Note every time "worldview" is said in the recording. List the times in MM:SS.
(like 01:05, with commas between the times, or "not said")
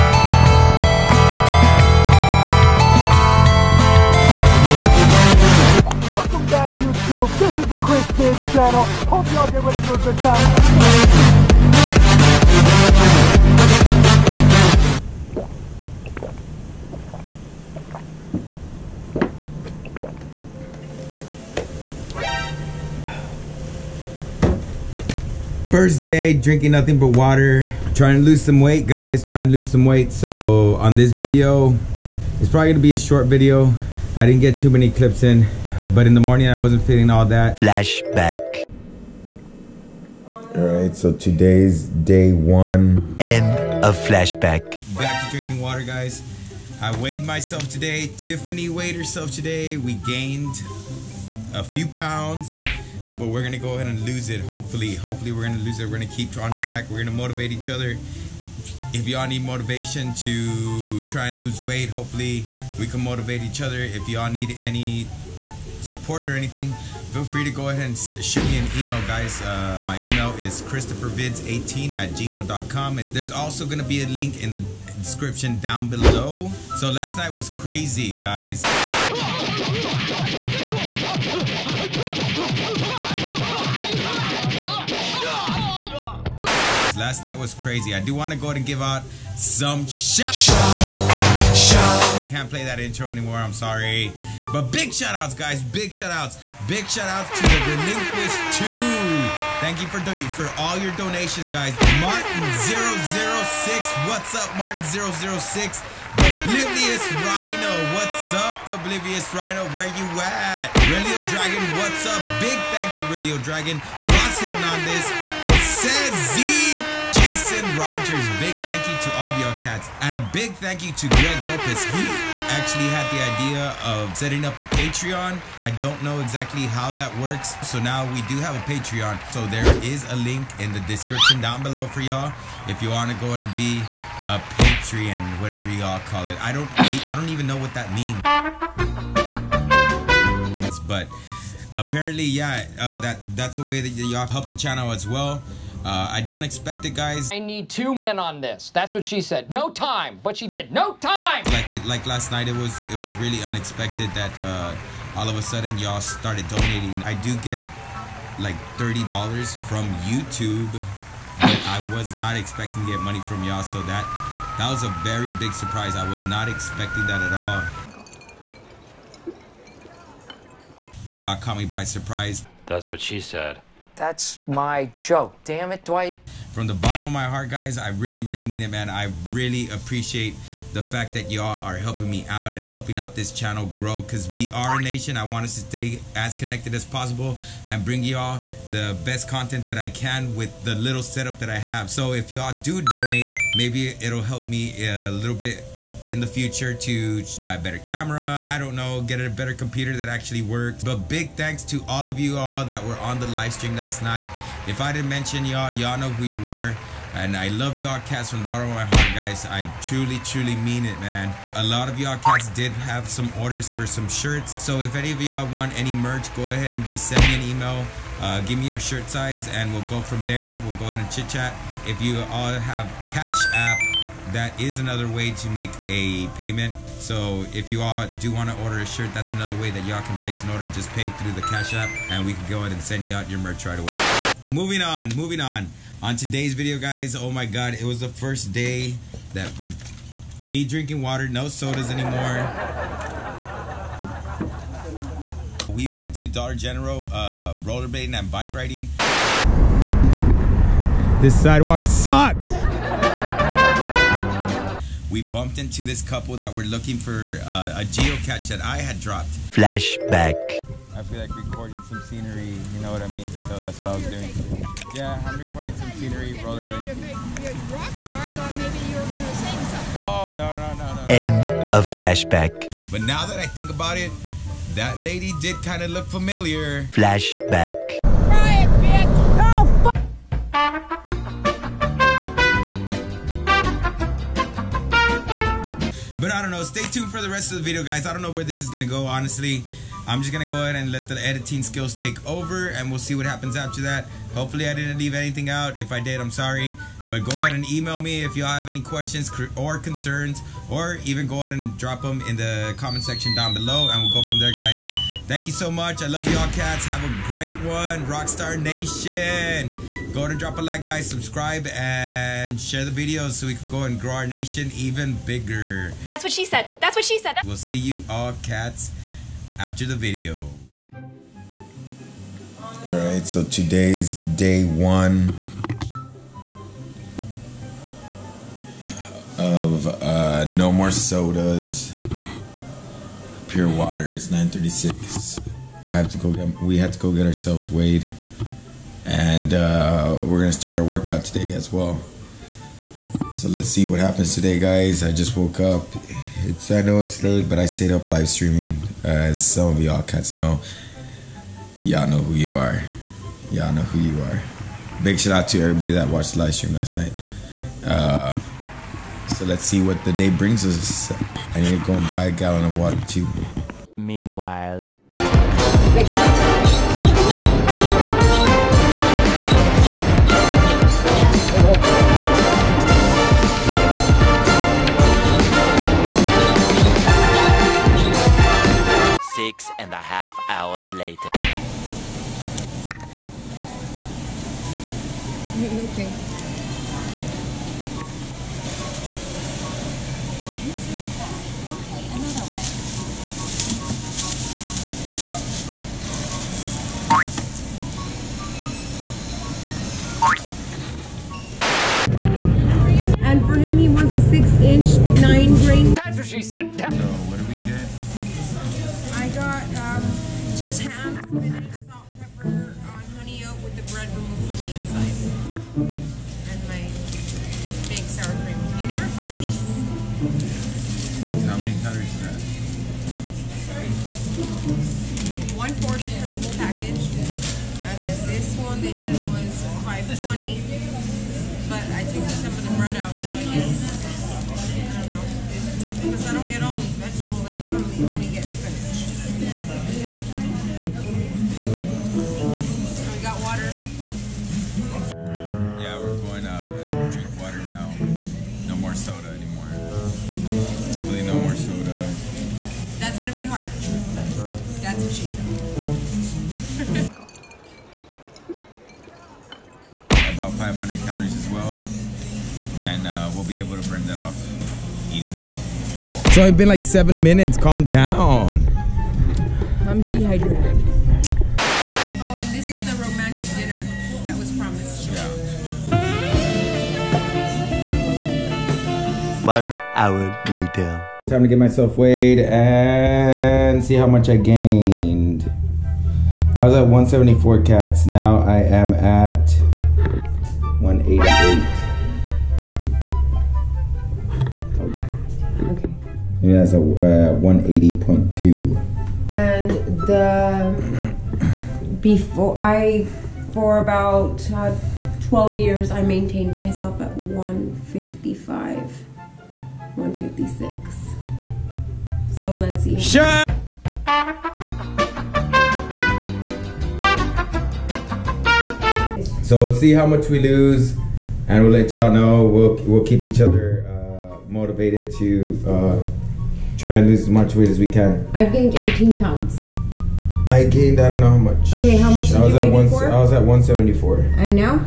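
not said.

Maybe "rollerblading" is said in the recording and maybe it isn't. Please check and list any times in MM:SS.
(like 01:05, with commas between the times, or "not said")
04:07, 04:26.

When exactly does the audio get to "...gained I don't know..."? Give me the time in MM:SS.
08:50.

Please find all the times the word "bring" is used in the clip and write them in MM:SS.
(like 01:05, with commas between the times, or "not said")
03:07, 06:00.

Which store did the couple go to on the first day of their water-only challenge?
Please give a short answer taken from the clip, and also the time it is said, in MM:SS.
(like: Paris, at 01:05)
Dollar General, at 04:06.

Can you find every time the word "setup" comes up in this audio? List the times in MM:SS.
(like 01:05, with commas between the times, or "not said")
03:11.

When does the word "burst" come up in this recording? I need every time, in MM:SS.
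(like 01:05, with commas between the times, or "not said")
not said.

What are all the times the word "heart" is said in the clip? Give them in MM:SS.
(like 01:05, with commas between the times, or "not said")
02:57, 03:28.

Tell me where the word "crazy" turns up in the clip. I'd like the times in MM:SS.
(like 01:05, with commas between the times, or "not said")
01:17, 01:27.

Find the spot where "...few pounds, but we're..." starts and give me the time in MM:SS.
00:51.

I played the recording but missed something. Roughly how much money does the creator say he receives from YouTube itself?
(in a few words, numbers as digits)
$30.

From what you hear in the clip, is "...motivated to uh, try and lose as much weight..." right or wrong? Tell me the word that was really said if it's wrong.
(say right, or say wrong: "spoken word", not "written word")
right.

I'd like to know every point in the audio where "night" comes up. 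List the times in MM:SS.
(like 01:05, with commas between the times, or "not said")
01:17, 01:27, 02:32, 03:24, 05:56.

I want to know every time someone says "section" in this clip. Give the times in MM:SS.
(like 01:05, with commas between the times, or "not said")
05:03.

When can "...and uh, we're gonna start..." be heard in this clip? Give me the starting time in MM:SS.
05:39.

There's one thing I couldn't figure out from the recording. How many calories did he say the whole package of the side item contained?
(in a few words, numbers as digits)
140.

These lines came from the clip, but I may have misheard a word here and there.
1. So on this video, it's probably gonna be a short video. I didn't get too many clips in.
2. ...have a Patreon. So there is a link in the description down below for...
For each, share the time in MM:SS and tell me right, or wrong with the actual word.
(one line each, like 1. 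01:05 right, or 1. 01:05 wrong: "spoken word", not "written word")
1. 00:30 right
2. 02:08 right.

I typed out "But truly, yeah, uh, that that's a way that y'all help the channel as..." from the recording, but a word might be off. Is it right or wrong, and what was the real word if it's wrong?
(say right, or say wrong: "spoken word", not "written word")
wrong: "apparently", not "truly".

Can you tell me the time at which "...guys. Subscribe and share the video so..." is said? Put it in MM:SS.
05:10.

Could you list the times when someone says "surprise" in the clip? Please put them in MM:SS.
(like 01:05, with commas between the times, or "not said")
02:45, 02:51.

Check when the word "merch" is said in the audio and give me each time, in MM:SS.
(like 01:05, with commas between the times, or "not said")
03:35, 03:53.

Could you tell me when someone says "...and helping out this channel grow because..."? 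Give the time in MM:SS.
03:02.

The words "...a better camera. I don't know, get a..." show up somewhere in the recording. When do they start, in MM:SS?
03:17.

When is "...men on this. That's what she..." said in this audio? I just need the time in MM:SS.
02:27.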